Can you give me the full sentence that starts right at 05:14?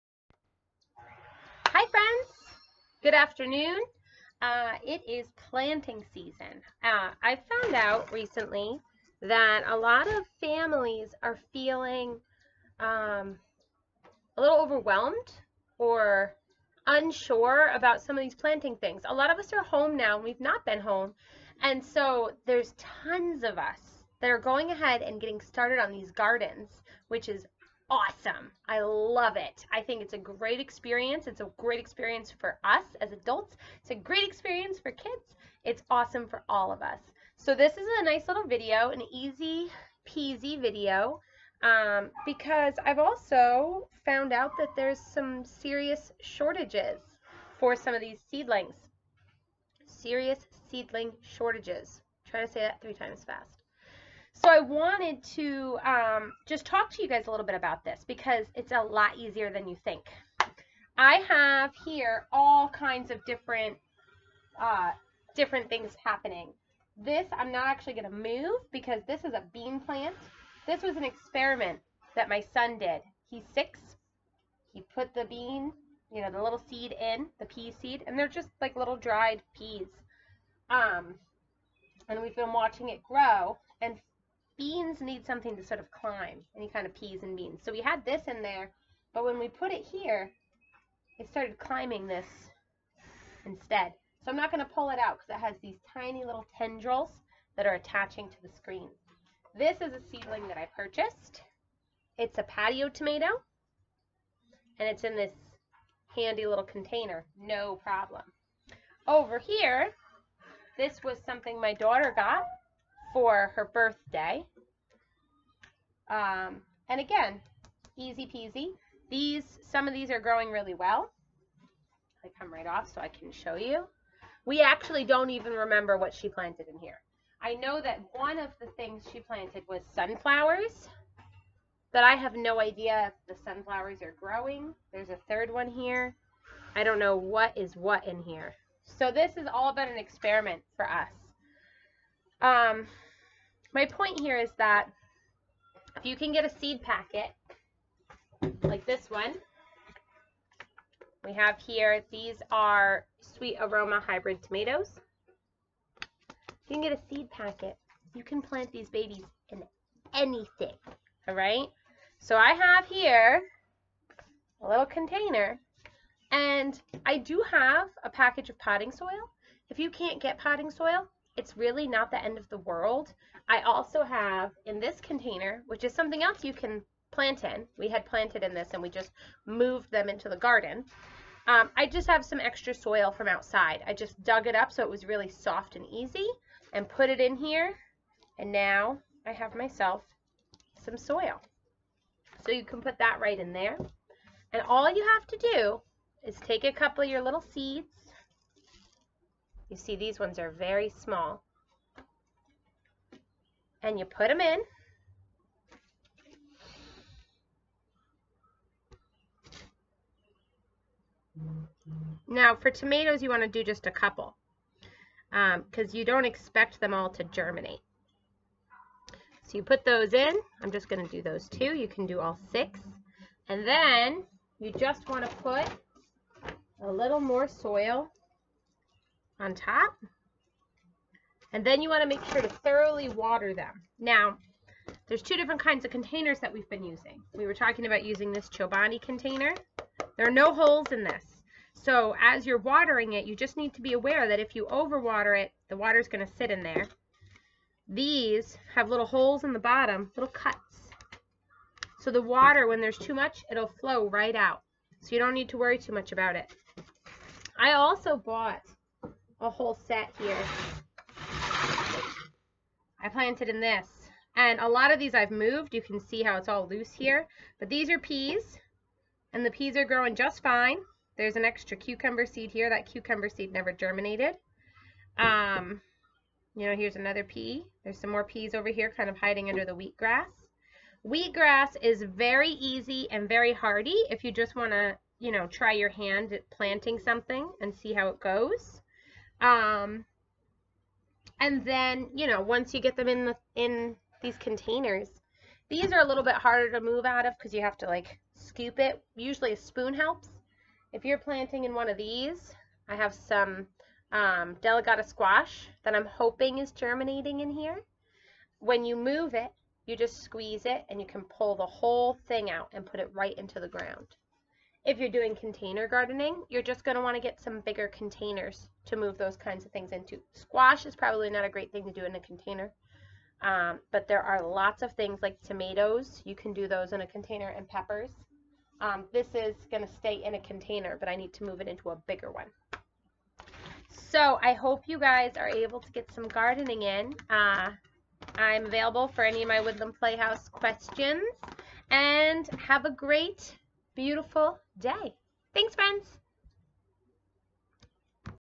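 If you're doing container gardening, you're just going to want to get some bigger containers to move those kinds of things into.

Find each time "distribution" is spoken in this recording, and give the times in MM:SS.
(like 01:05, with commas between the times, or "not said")
not said.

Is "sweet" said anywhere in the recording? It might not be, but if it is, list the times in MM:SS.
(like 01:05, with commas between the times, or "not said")
02:33.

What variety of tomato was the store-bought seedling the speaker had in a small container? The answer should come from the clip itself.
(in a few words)
Patio tomato.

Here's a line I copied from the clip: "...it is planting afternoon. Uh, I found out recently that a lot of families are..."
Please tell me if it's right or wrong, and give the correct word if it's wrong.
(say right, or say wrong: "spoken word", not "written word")
wrong: "season", not "afternoon".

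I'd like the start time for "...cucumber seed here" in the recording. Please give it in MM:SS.
04:31.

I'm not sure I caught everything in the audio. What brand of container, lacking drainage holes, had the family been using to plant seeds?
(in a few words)
Chobani.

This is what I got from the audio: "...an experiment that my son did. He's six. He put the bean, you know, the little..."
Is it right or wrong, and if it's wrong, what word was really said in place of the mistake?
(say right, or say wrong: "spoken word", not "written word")
right.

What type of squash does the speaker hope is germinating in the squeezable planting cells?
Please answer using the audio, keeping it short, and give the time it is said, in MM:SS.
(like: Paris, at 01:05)
Delicata, at 05:04.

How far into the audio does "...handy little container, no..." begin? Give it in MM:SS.
01:46.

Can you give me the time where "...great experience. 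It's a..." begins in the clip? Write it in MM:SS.
00:30.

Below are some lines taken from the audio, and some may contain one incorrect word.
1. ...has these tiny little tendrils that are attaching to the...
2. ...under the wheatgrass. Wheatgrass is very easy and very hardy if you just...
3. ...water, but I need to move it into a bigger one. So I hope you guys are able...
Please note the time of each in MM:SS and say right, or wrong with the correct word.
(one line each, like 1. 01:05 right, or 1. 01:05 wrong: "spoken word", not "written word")
1. 01:35 right
2. 04:39 right
3. 05:30 wrong: "container", not "water".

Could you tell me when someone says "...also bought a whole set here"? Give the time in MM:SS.
04:17.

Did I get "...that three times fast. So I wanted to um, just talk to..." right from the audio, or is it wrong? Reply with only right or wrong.
right.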